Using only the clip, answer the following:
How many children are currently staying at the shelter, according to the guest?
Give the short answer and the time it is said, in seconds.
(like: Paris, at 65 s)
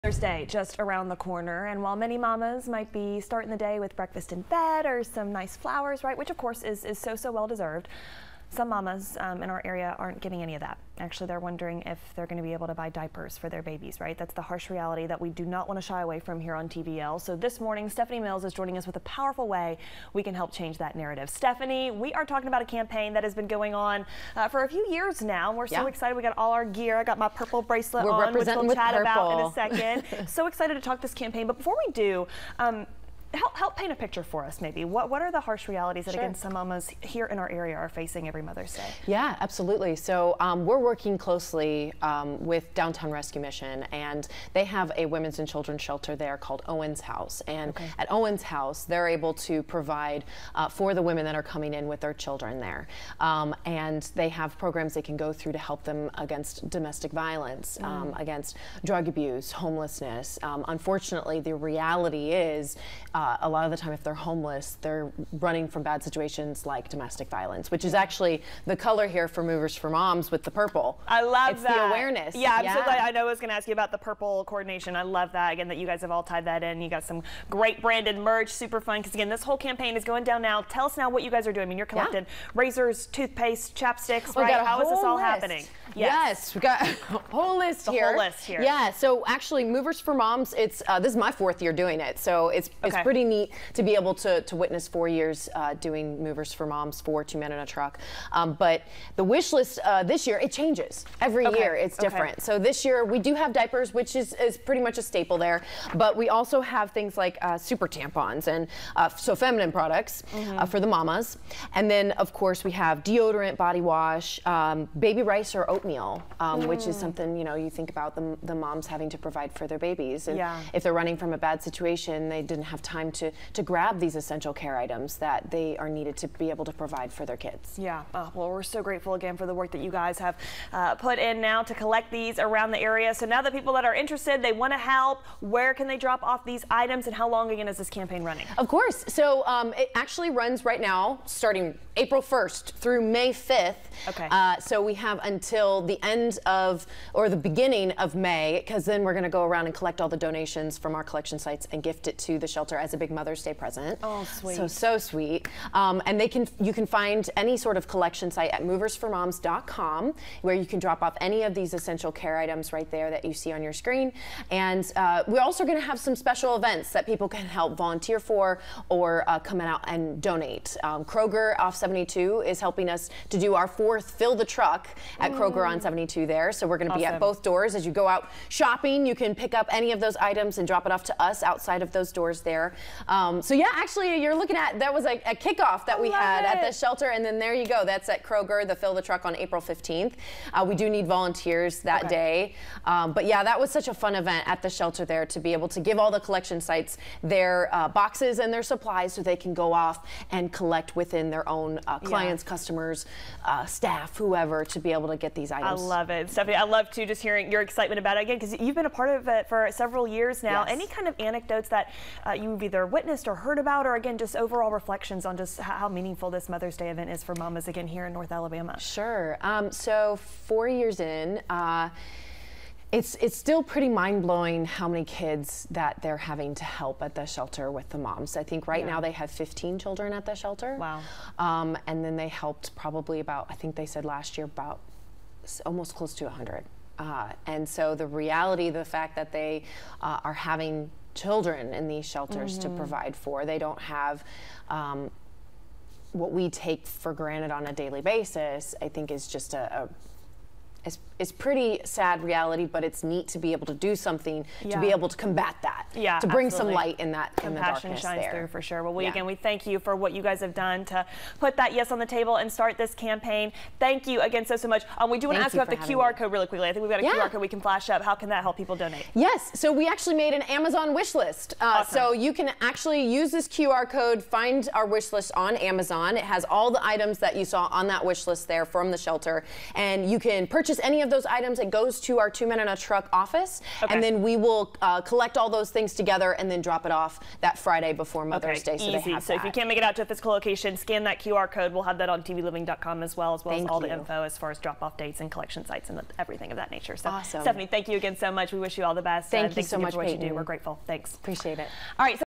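15, at 229 s.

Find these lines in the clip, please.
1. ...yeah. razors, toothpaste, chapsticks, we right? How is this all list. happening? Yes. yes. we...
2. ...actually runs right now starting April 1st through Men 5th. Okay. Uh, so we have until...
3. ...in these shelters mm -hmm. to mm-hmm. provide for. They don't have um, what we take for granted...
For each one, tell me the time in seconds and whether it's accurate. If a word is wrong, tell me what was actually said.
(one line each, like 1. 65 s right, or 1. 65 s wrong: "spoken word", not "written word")
1. 82 s right
2. 139 s wrong: "May", not "Men"
3. 241 s right.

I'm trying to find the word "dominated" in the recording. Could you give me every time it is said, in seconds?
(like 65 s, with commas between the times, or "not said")
not said.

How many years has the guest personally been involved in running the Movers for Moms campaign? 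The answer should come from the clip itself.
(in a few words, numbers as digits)
4.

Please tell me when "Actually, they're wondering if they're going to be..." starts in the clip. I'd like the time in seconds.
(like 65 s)
10 s.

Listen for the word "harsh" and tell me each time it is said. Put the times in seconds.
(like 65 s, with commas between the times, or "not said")
14 s, 35 s.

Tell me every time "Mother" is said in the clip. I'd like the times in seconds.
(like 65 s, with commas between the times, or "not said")
38 s, 153 s, 216 s, 288 s.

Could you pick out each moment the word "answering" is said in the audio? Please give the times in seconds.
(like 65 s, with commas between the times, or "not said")
not said.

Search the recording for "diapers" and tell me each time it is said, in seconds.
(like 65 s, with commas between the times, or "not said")
12 s, 103 s.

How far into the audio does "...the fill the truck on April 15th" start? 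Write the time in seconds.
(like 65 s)
188 s.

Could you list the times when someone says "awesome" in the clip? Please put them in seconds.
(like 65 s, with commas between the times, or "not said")
176 s, 271 s, 297 s.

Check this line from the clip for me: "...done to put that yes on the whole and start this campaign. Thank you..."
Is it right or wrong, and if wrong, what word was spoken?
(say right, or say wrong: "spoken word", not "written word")
wrong: "table", not "whole".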